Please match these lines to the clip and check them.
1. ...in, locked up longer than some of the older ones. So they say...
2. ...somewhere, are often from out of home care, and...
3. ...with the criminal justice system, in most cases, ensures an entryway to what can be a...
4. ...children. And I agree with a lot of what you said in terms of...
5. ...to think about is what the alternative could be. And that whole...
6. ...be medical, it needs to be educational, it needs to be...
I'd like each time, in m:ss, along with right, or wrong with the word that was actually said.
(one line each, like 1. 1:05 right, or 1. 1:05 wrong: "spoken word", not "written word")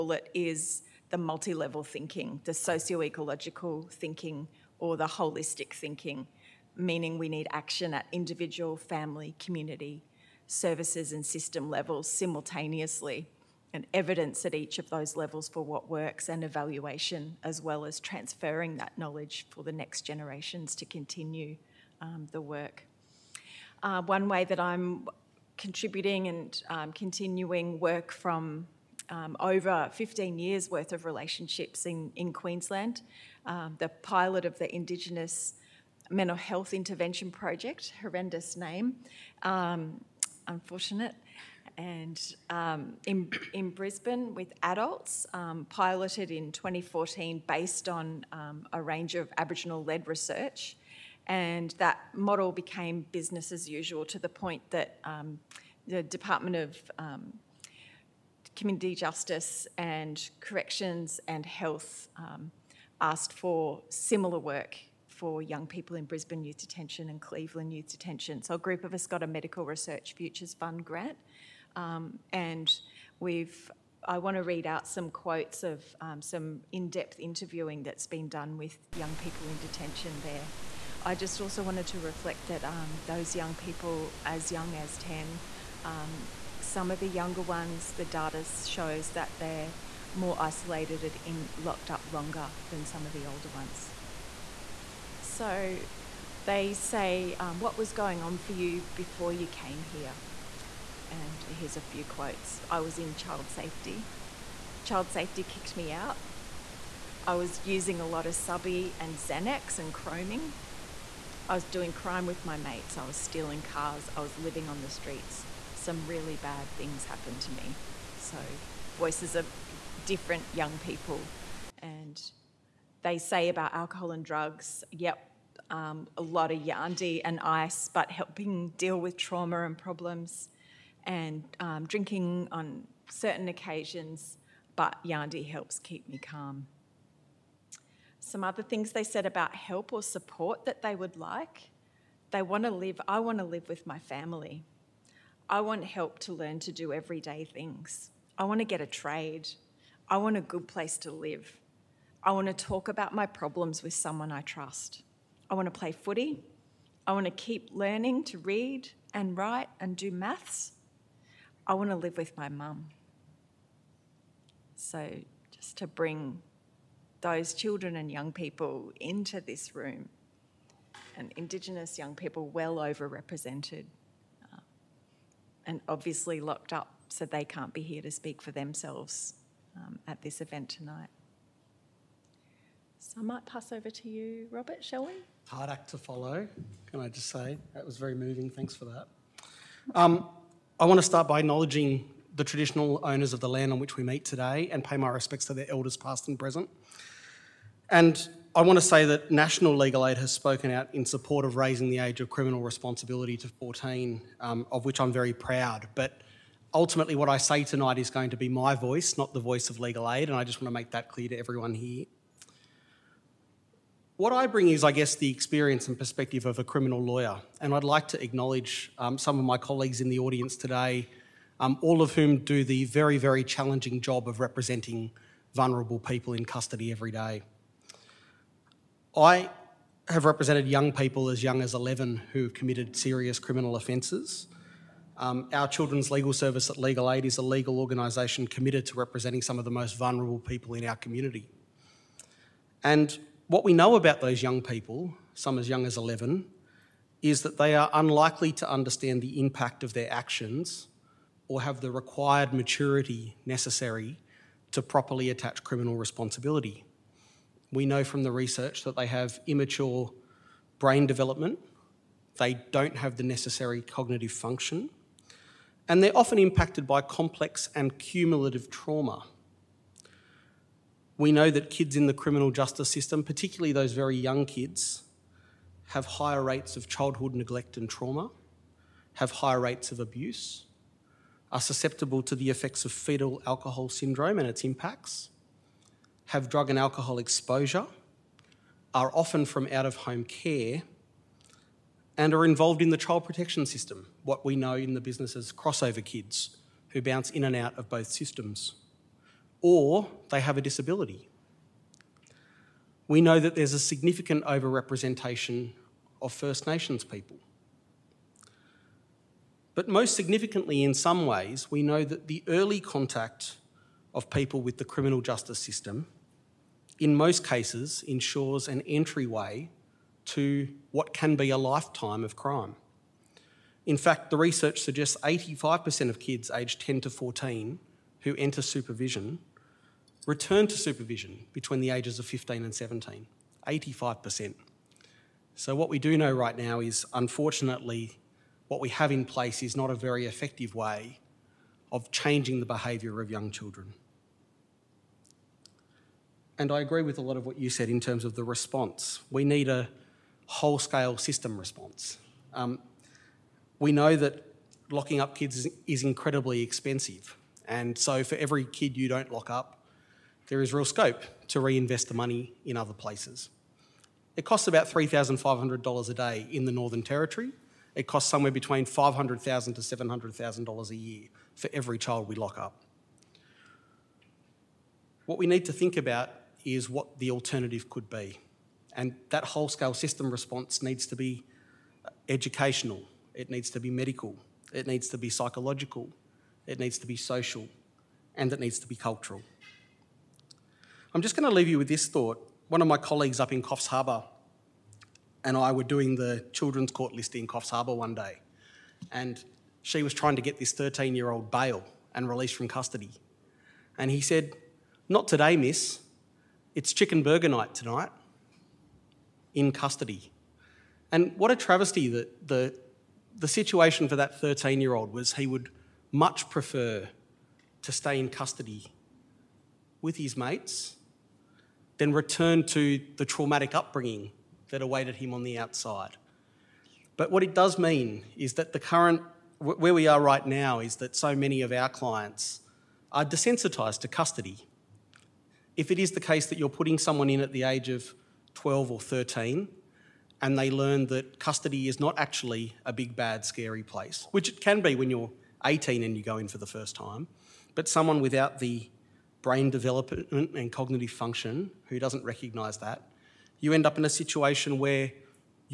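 1. 1:31 right
2. 4:47 wrong: "exposure", not "somewhere"
3. 5:14 right
4. 5:43 right
5. 6:15 right
6. 6:23 wrong: "psychological", not "educational".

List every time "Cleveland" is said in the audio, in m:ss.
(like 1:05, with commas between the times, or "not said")
1:07.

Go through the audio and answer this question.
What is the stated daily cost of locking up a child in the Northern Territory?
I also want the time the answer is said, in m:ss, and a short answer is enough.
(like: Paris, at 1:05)
$3,500, at 6:04.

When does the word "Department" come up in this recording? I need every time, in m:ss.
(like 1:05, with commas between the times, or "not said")
0:56.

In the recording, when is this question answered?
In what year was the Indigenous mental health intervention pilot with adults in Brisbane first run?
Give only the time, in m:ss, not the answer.
0:46.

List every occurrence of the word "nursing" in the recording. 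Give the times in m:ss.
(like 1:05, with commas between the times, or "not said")
not said.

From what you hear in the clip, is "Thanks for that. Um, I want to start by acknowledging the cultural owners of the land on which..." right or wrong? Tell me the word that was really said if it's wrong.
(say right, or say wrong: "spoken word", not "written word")
wrong: "traditional", not "cultural".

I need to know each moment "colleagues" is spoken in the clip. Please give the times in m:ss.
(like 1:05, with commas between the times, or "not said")
3:39, 6:32.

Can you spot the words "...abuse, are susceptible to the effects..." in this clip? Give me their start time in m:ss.
4:39.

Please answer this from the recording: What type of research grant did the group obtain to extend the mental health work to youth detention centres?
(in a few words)
Medical Research Futures Fund.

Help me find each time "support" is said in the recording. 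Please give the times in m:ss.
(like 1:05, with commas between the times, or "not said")
2:20, 3:21.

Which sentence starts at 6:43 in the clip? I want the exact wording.
And he said, Not today, miss.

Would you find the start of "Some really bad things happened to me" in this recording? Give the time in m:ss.
1:55.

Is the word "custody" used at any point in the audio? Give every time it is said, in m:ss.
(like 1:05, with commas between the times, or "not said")
3:46, 6:42, 6:49, 6:58, 7:14, 7:21.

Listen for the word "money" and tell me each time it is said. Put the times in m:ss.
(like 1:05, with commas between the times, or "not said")
6:02.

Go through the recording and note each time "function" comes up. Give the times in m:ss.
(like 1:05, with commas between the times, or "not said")
4:24, 7:31.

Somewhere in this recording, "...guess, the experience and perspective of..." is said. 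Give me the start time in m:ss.
3:34.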